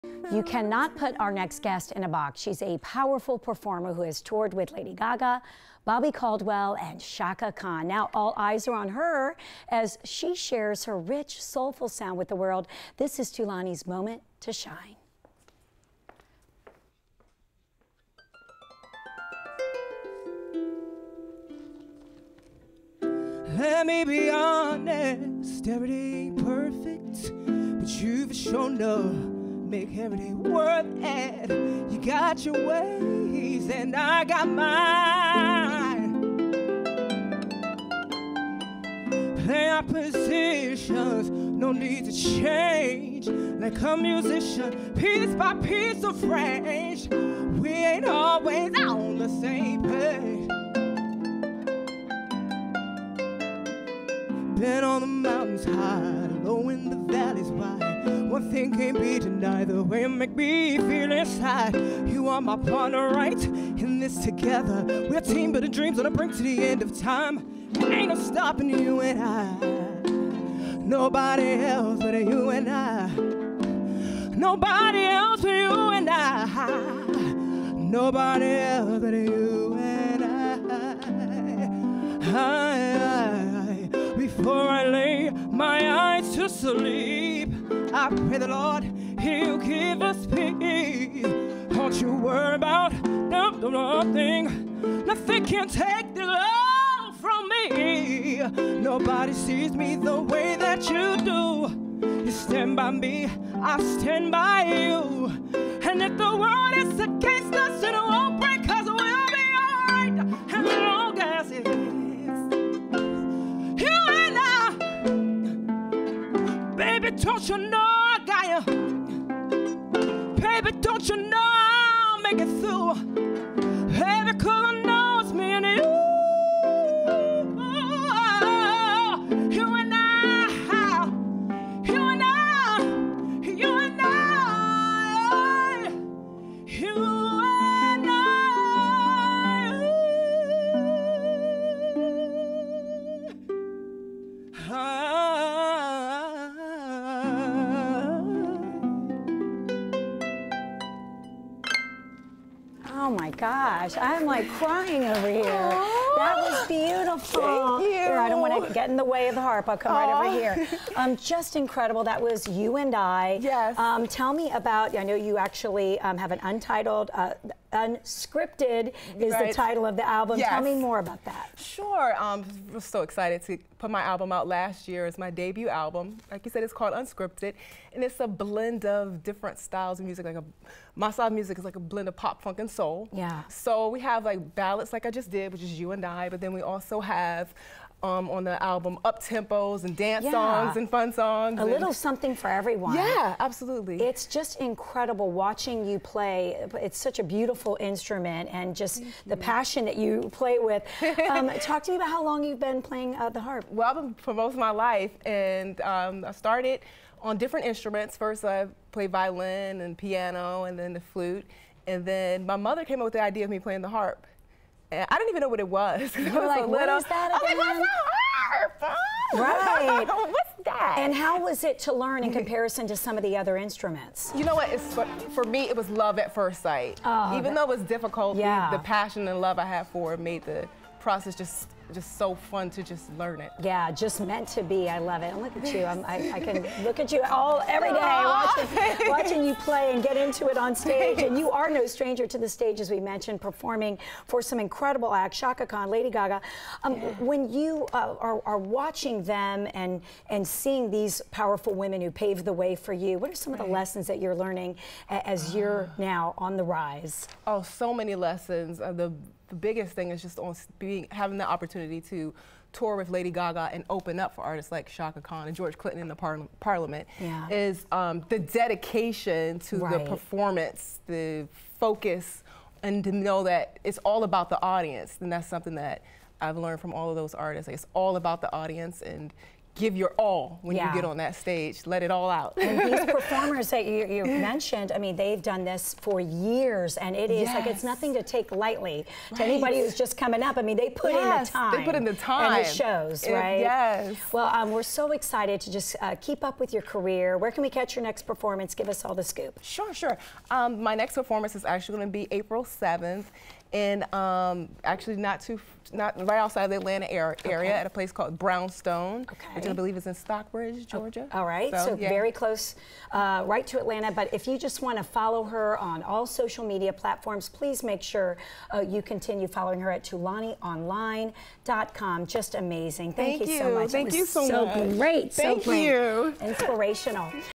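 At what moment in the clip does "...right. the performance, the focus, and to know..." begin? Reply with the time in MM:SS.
04:29.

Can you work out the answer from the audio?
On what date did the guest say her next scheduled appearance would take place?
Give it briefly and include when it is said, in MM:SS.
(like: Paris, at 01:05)
April 7, at 05:02.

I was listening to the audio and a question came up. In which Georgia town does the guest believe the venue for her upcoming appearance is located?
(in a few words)
Stockbridge.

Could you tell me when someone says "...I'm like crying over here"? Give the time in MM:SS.
02:33.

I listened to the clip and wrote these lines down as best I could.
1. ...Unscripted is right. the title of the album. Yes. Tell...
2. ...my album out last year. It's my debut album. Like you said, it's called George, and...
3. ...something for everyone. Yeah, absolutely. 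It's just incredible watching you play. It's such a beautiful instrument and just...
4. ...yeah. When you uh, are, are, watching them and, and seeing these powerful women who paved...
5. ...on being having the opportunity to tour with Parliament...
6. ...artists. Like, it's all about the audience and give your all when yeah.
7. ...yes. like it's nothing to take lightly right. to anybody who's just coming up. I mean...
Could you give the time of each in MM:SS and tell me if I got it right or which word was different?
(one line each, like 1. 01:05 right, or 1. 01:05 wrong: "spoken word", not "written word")
1. 02:47 right
2. 02:53 wrong: "Unscripted", not "George"
3. 03:11 right
4. 04:06 right
5. 04:20 wrong: "Lady", not "Parliament"
6. 04:37 right
7. 04:47 right.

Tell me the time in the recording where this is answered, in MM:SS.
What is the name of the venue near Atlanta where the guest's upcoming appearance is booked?
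05:08.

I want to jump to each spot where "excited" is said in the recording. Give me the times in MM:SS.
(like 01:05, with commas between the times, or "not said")
02:53, 04:55.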